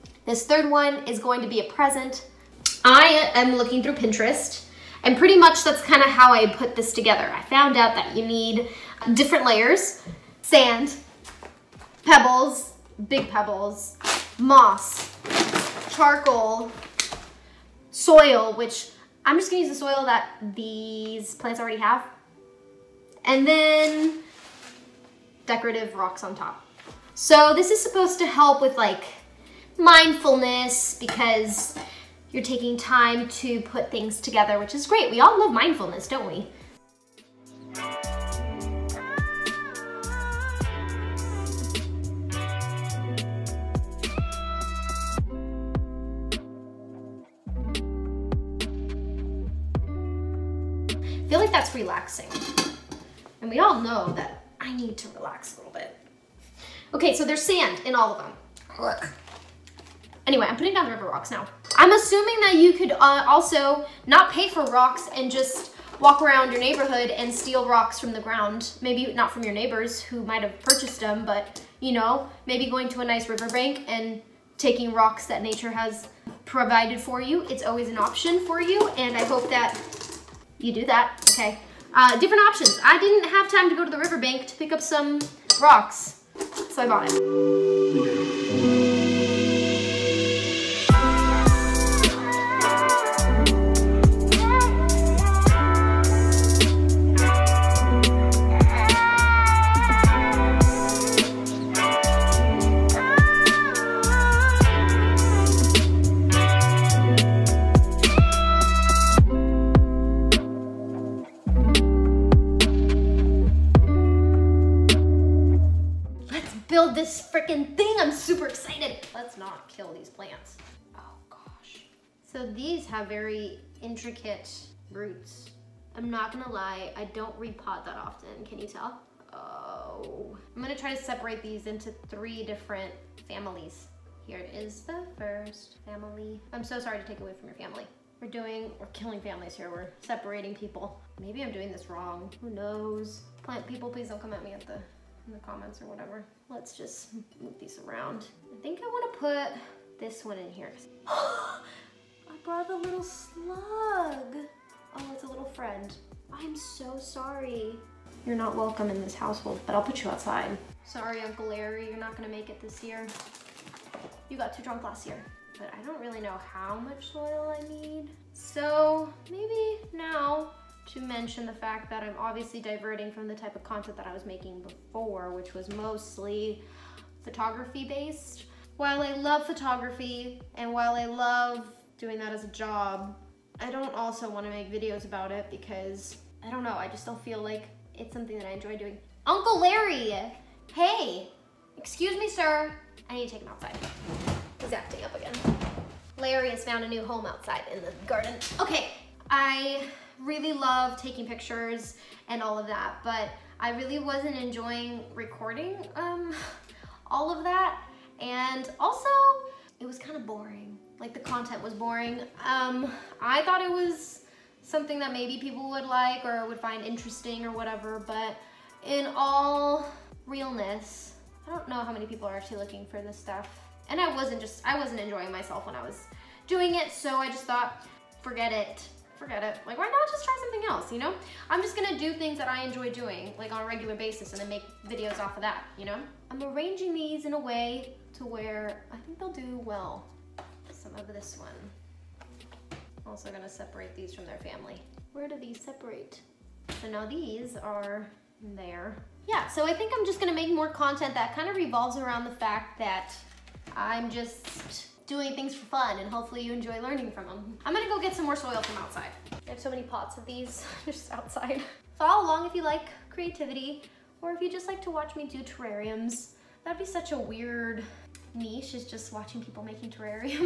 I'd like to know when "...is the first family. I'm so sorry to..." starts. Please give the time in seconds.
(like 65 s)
134 s.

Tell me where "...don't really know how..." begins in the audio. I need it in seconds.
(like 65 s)
165 s.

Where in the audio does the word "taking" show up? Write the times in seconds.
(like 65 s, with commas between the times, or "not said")
32 s, 74 s, 200 s.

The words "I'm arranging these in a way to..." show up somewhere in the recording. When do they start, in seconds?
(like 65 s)
236 s.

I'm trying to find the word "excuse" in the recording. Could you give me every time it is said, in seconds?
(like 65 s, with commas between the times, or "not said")
191 s.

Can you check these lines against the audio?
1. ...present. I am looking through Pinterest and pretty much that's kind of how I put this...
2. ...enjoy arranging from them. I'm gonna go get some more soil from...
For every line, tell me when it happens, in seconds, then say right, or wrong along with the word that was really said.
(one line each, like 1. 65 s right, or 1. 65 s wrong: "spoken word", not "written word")
1. 1 s right
2. 256 s wrong: "learning", not "arranging".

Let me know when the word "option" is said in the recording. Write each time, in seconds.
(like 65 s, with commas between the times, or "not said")
77 s, 82 s.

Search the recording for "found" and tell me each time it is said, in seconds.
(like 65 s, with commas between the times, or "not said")
7 s, 196 s.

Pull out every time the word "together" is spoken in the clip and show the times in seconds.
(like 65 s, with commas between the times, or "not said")
6 s, 34 s.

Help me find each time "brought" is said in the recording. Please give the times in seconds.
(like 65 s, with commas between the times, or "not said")
152 s.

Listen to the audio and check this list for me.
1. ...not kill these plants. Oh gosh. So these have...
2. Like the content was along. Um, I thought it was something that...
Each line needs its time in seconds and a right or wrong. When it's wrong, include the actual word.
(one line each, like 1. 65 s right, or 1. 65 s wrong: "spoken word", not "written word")
1. 119 s right
2. 210 s wrong: "boring", not "along".